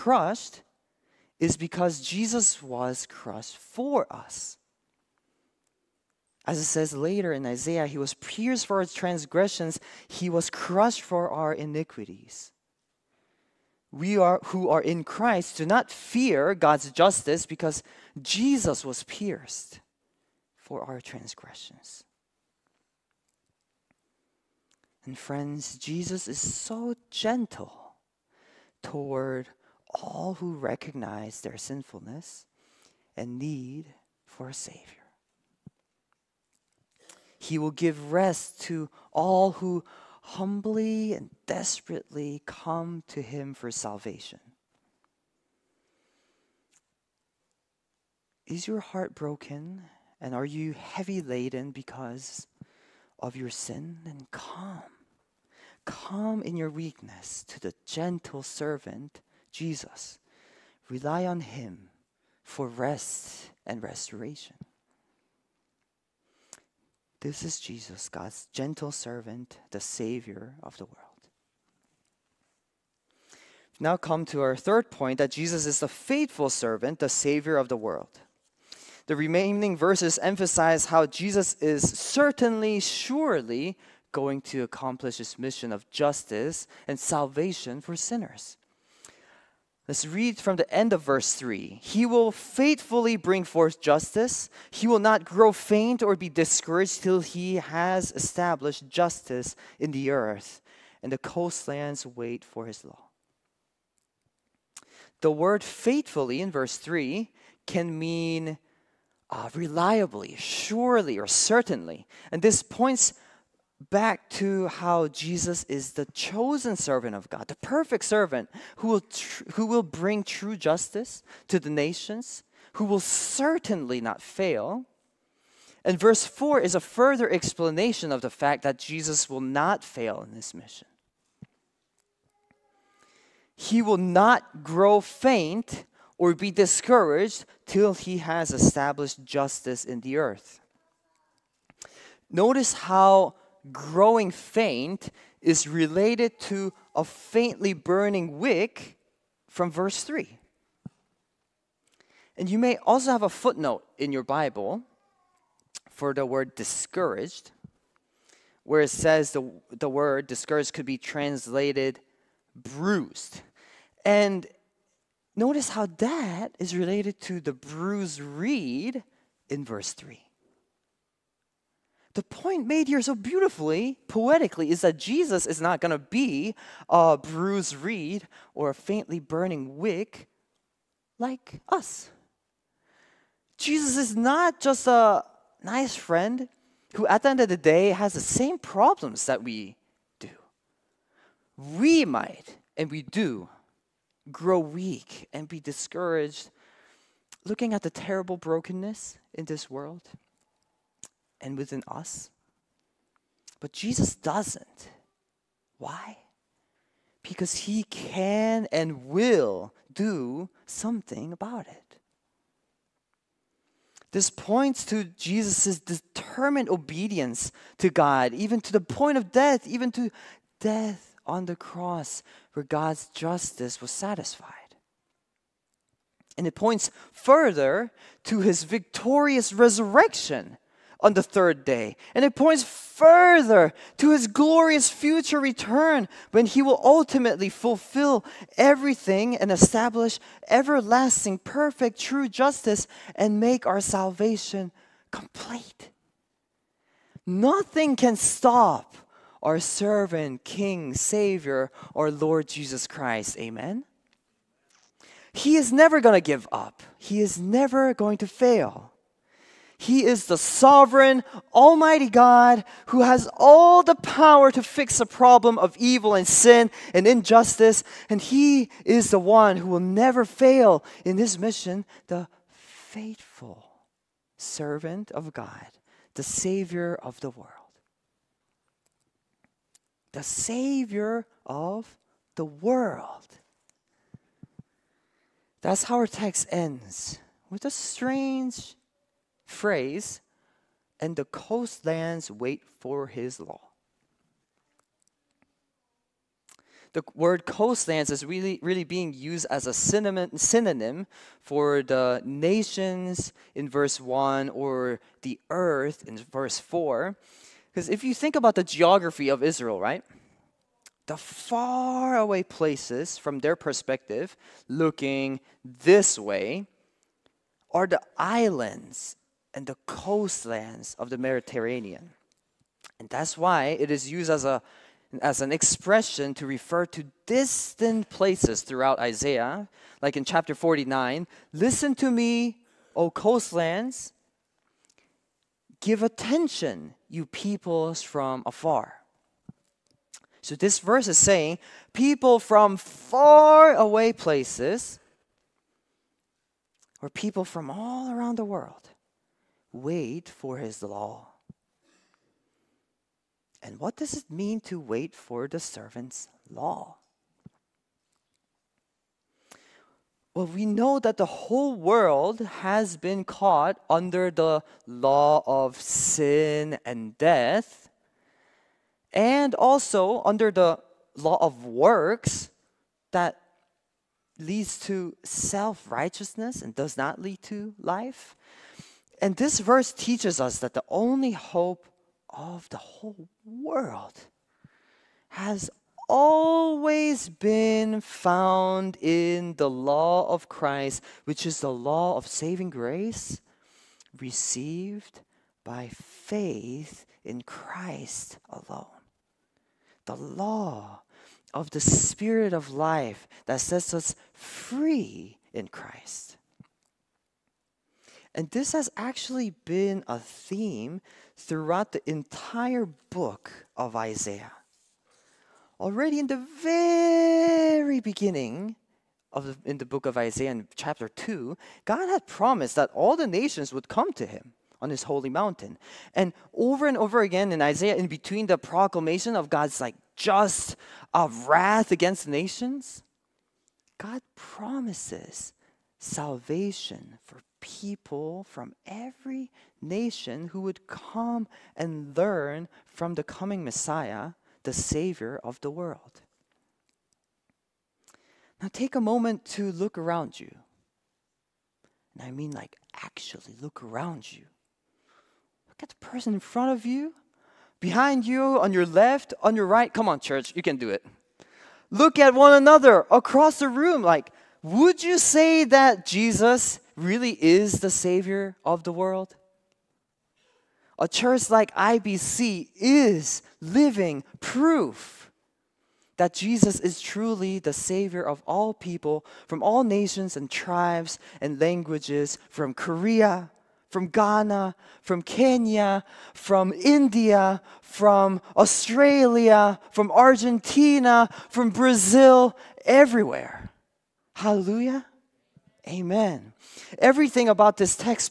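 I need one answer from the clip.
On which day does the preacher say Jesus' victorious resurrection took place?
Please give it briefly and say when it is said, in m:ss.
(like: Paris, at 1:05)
the third day, at 3:51.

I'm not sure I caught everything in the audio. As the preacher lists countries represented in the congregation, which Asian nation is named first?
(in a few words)
Korea.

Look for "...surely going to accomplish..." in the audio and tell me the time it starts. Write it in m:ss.
1:22.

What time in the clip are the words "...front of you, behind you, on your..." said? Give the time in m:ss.
7:36.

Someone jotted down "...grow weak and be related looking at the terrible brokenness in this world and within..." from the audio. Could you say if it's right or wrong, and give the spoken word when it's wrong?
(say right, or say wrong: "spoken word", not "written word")
wrong: "discouraged", not "related".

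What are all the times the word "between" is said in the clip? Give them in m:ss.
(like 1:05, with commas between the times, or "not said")
7:08.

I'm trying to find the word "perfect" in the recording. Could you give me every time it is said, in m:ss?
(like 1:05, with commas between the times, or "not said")
1:57, 4:01.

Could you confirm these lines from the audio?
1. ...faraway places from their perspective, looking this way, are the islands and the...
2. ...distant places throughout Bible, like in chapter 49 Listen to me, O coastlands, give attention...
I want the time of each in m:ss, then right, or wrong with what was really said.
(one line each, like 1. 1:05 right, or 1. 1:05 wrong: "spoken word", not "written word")
1. 5:11 right
2. 5:27 wrong: "Isaiah", not "Bible".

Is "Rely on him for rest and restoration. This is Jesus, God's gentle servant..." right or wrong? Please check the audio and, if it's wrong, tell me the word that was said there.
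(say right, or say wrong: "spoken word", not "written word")
right.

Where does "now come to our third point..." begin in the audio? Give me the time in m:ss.
1:13.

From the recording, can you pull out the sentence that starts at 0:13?
We are who are in Christ do not fear God's justice because Jesus was pierced for our transgressions.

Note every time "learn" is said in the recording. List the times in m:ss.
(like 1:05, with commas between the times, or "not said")
7:22.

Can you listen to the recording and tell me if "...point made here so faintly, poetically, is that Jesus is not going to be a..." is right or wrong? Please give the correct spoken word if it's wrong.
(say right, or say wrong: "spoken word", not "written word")
wrong: "beautifully", not "faintly".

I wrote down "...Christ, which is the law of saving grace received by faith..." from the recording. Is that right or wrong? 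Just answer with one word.
right.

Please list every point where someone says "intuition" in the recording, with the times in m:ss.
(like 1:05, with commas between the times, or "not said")
not said.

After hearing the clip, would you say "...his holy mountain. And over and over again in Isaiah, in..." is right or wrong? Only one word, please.
right.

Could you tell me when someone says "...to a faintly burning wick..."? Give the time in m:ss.
2:26.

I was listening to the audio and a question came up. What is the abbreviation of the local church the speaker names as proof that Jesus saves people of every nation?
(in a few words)
IBC.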